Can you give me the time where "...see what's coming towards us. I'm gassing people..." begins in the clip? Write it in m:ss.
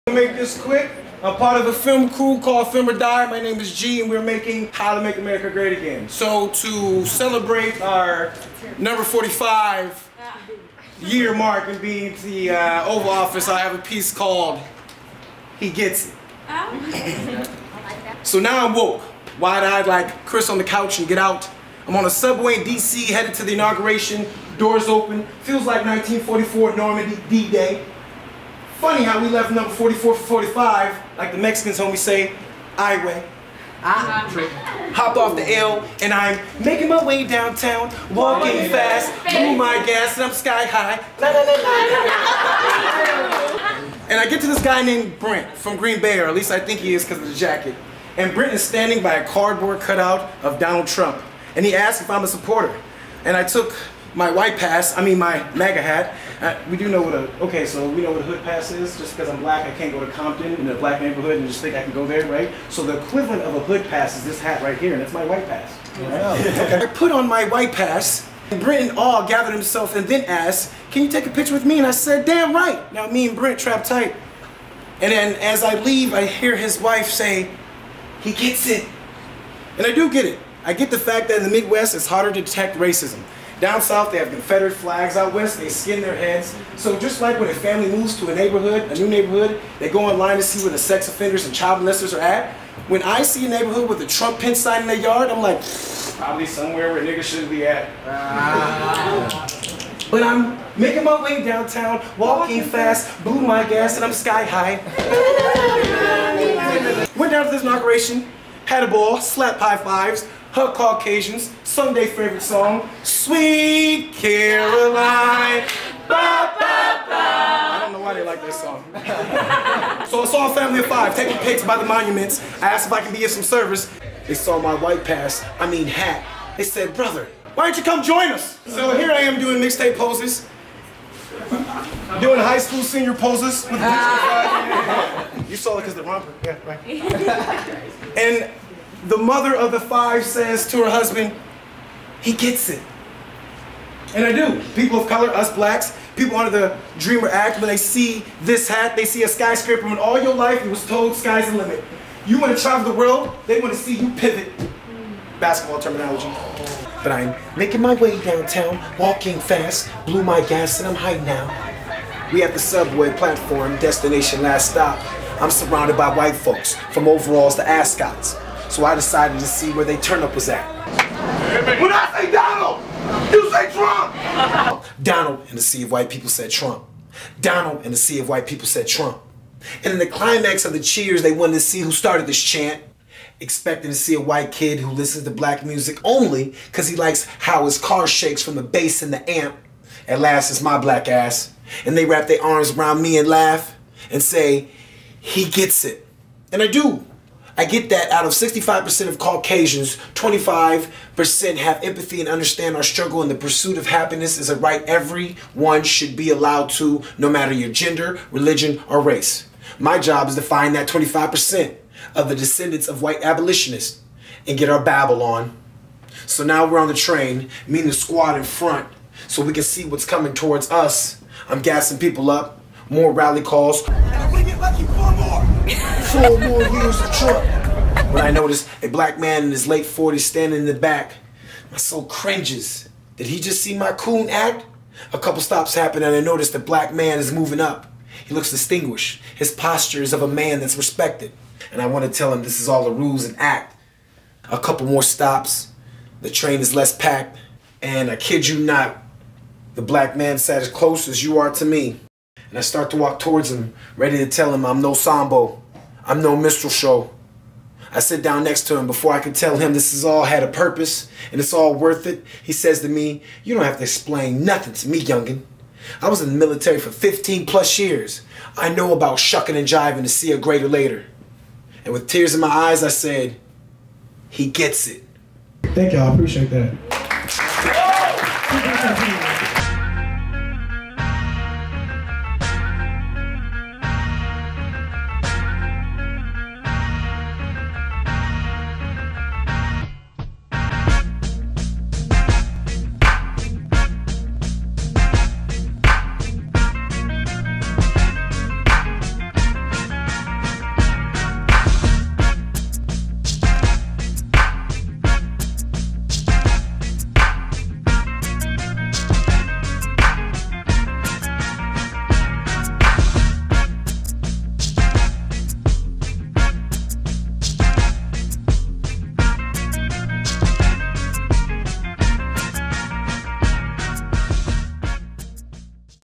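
3:39.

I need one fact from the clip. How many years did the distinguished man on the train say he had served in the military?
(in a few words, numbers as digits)
15 plus years.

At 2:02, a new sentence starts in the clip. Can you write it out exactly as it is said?
I asked if I can be of some service.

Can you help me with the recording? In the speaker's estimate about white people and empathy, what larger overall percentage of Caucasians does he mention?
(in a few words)
65%.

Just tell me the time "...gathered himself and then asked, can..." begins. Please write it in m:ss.
1:09.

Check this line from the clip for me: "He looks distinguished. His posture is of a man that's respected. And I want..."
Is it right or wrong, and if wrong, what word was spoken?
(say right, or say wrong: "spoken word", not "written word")
right.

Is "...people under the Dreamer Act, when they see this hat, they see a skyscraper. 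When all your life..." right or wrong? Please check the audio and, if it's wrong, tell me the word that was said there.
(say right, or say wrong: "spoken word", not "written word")
right.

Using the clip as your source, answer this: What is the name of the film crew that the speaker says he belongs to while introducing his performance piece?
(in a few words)
Film or Die.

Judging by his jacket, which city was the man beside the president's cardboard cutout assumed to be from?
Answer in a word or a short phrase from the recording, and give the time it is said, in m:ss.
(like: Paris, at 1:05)
Green Bay, at 0:45.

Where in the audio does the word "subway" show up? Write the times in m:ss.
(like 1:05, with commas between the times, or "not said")
0:22, 2:42.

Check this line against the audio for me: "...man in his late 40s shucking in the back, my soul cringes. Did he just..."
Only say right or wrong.
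wrong.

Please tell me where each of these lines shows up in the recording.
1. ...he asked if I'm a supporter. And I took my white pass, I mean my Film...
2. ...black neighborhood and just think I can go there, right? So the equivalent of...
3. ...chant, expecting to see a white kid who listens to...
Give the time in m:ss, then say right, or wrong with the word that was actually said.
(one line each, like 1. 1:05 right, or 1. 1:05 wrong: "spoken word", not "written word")
1. 0:51 wrong: "MAGA", not "Film"
2. 1:00 right
3. 3:02 right.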